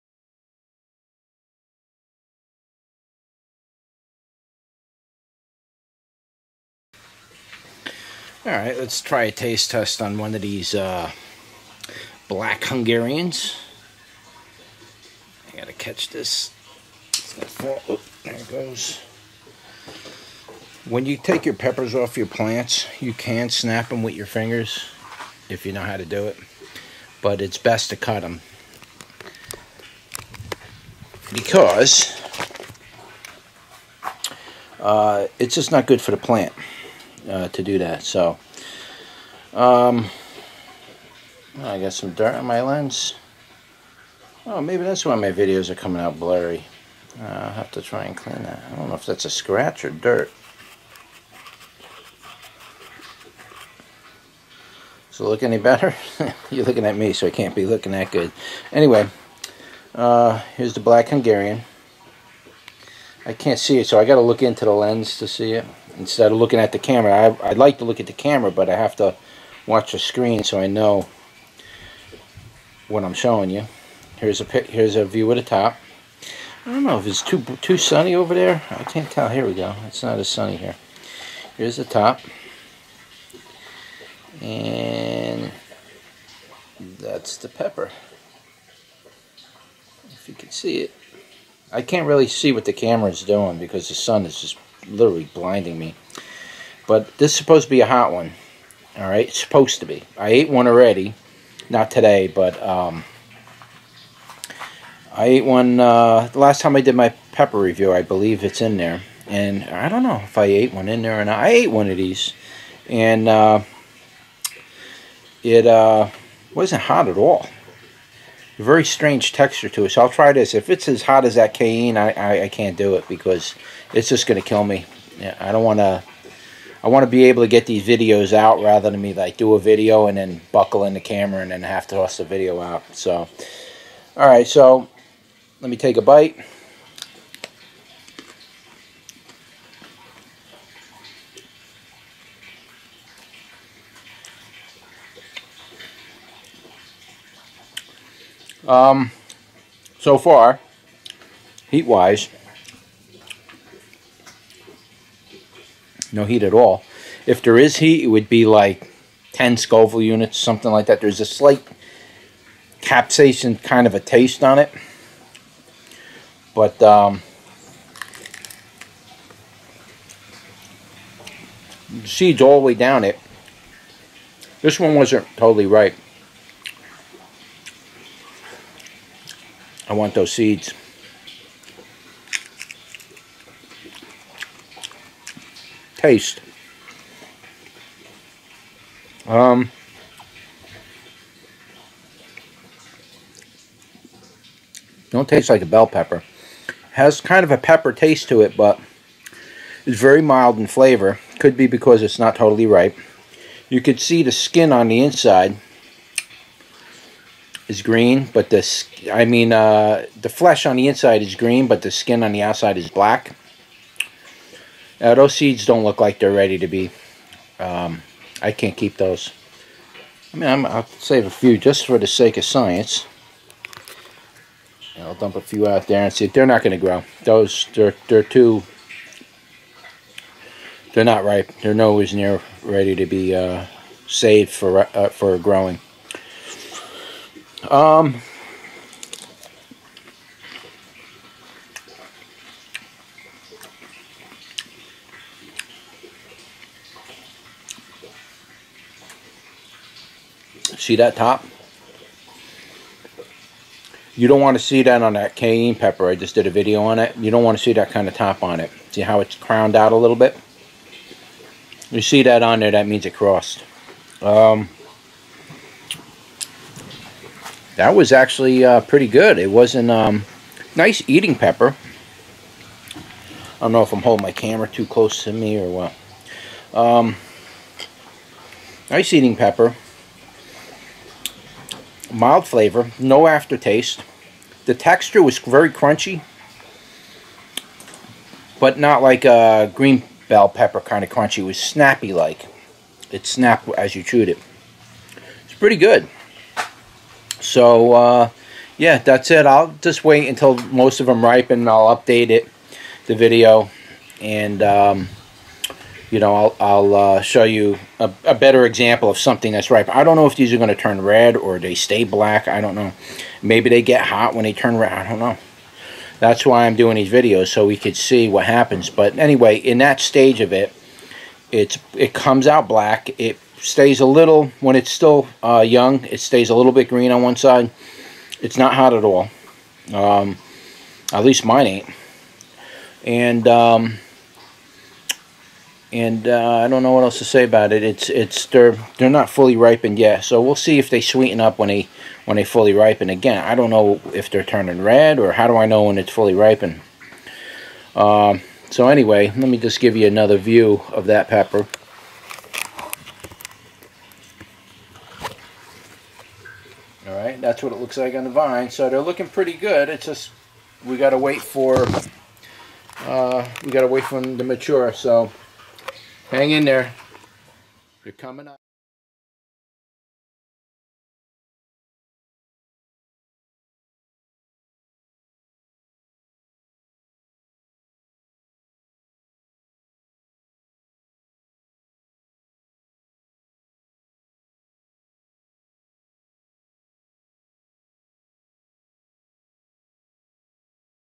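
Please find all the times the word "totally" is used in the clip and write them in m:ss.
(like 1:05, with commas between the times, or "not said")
2:55, 3:22.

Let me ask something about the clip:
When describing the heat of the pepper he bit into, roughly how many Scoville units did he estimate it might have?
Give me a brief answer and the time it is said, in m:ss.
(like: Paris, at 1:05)
10, at 2:39.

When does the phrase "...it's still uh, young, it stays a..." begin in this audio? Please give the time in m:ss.
5:24.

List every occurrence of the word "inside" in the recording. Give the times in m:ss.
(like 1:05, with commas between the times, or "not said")
3:25, 3:30.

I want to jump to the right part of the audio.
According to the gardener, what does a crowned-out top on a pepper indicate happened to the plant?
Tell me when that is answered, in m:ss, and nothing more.
4:22.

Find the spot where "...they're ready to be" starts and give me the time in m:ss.
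3:36.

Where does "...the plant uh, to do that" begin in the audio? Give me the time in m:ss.
0:36.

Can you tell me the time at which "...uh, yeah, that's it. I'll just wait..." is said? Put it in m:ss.
4:57.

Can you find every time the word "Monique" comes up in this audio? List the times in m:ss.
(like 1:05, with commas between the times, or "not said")
not said.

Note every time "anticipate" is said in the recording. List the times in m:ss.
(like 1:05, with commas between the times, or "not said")
not said.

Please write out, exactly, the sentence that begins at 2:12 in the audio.
So, all right, so let me take a bite.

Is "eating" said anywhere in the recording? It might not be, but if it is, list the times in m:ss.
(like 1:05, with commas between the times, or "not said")
4:31, 4:39.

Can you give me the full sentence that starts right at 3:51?
They're nowhere near ready to be uh, saved for uh, for growing.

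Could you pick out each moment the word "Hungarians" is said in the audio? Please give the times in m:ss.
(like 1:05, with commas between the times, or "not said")
0:12, 1:01.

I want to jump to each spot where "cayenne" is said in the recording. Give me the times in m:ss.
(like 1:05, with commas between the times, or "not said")
2:01, 4:15.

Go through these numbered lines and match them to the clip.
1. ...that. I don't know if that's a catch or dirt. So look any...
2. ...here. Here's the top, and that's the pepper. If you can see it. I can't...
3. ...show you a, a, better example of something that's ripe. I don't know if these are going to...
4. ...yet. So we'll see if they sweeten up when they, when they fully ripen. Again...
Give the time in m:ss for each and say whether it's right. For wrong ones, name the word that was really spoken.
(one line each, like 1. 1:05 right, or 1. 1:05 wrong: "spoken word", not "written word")
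1. 0:48 wrong: "scratch", not "catch"
2. 1:20 right
3. 5:07 right
4. 5:39 right.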